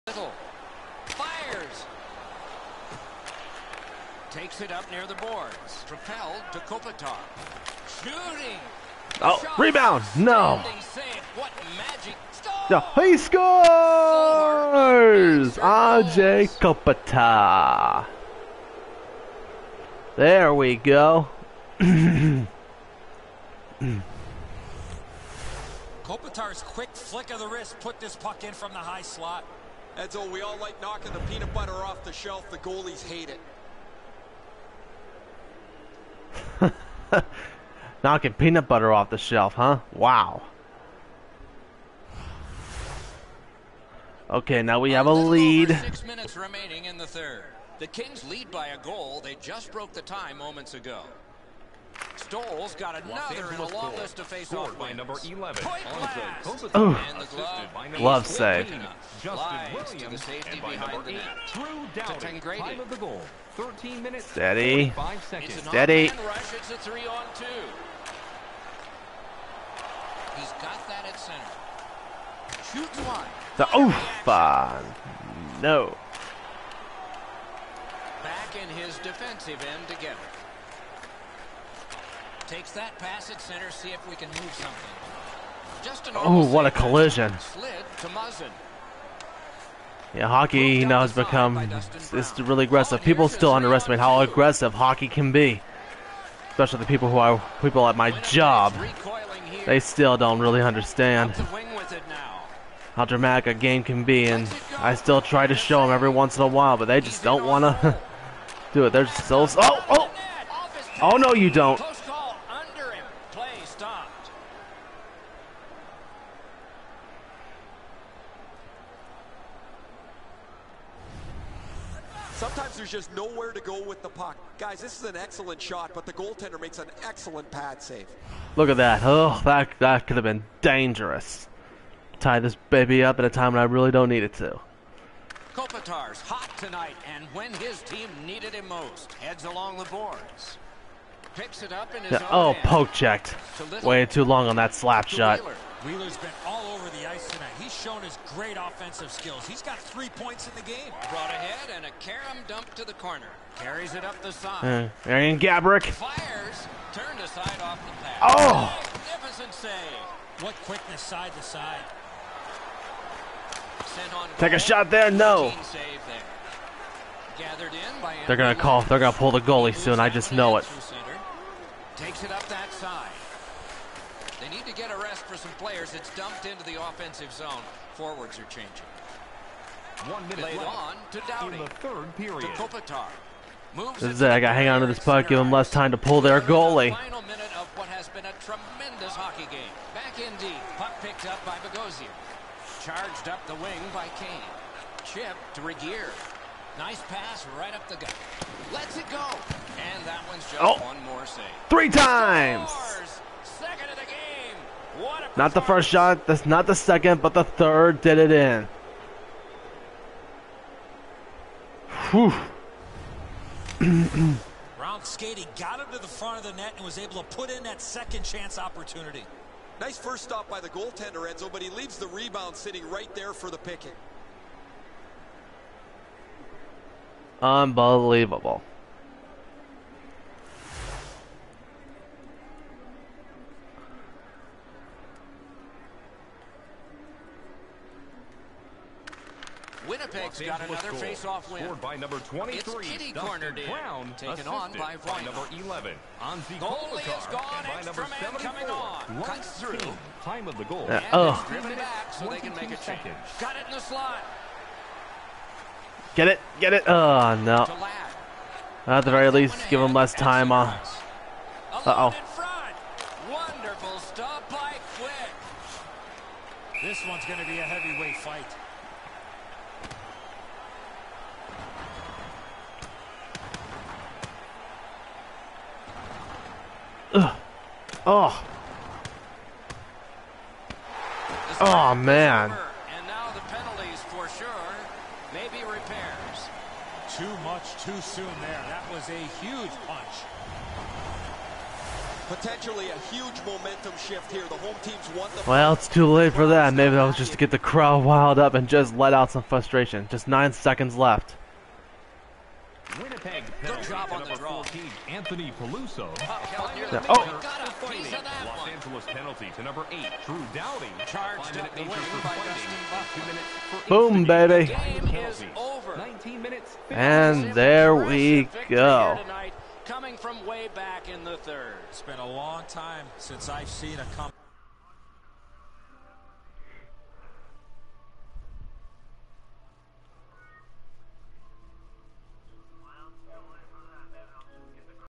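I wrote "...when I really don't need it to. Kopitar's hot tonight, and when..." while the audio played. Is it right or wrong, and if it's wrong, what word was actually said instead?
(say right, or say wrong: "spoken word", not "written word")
right.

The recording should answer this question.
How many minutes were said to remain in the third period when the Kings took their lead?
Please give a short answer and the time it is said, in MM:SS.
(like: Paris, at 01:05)
6, at 00:45.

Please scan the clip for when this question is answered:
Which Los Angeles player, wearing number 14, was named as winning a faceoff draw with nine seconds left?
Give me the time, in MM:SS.
05:05.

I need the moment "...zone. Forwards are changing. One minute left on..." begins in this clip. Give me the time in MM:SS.
02:57.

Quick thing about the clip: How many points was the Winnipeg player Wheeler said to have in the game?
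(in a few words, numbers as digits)
3.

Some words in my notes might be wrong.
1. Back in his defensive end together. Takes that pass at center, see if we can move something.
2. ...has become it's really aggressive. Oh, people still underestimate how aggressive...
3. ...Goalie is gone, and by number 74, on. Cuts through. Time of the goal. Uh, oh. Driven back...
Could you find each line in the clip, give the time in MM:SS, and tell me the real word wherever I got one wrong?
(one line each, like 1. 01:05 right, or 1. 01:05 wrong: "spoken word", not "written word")
1. 01:18 right
2. 01:30 right
3. 04:06 right.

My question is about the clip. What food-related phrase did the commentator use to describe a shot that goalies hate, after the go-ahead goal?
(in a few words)
knocking the peanut butter off the shelf.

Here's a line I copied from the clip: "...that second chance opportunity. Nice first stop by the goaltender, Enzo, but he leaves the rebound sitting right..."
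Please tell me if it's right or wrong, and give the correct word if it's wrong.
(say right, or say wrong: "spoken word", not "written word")
right.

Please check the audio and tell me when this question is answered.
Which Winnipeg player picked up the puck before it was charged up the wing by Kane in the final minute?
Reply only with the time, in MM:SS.
03:11.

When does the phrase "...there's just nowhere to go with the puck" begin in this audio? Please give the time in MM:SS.
02:02.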